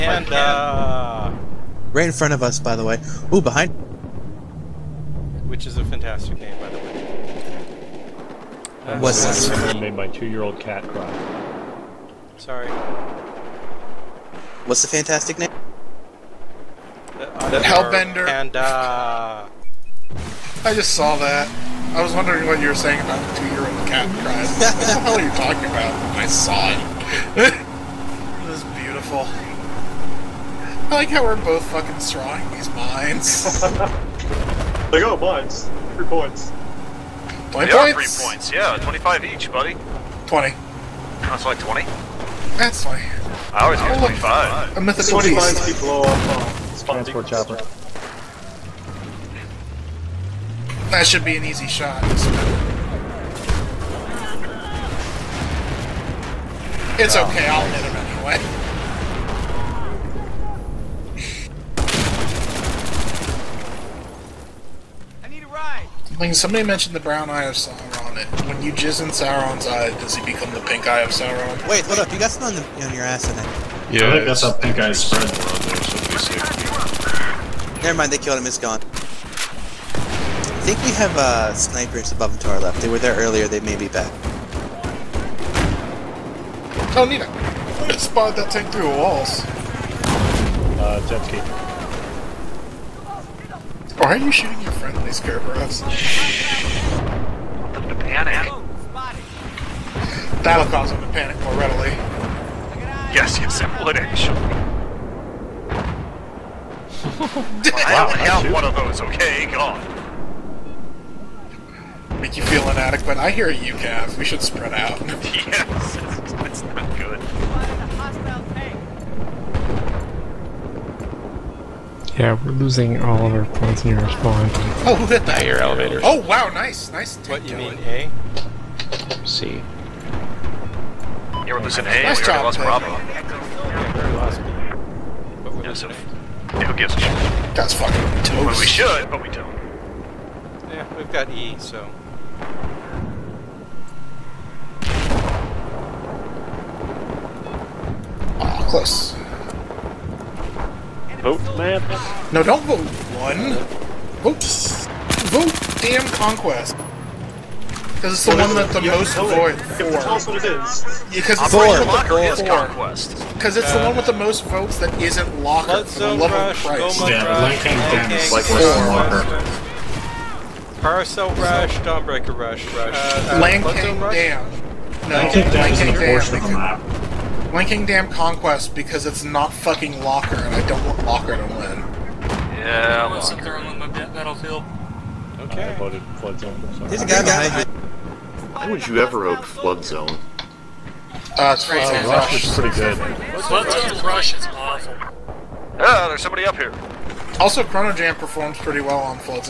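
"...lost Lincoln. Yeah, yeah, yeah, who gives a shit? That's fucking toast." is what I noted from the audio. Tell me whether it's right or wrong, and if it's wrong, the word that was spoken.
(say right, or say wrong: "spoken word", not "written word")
wrong: "Bravo", not "Lincoln".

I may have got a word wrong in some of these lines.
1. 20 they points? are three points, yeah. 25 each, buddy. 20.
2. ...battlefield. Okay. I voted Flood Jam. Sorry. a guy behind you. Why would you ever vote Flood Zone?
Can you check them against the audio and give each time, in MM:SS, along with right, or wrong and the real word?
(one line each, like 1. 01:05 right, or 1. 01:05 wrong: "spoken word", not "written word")
1. 00:37 right
2. 03:04 wrong: "Zone", not "Jam".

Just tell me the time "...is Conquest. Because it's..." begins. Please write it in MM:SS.
02:42.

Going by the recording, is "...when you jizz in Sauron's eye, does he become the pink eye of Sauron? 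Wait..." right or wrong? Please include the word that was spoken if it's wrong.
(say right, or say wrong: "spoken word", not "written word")
right.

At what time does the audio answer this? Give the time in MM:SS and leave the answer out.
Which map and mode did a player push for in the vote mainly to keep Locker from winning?
02:57.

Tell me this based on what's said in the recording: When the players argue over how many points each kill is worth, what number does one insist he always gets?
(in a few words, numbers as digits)
25.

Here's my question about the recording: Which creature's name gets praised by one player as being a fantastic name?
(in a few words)
Hellbender.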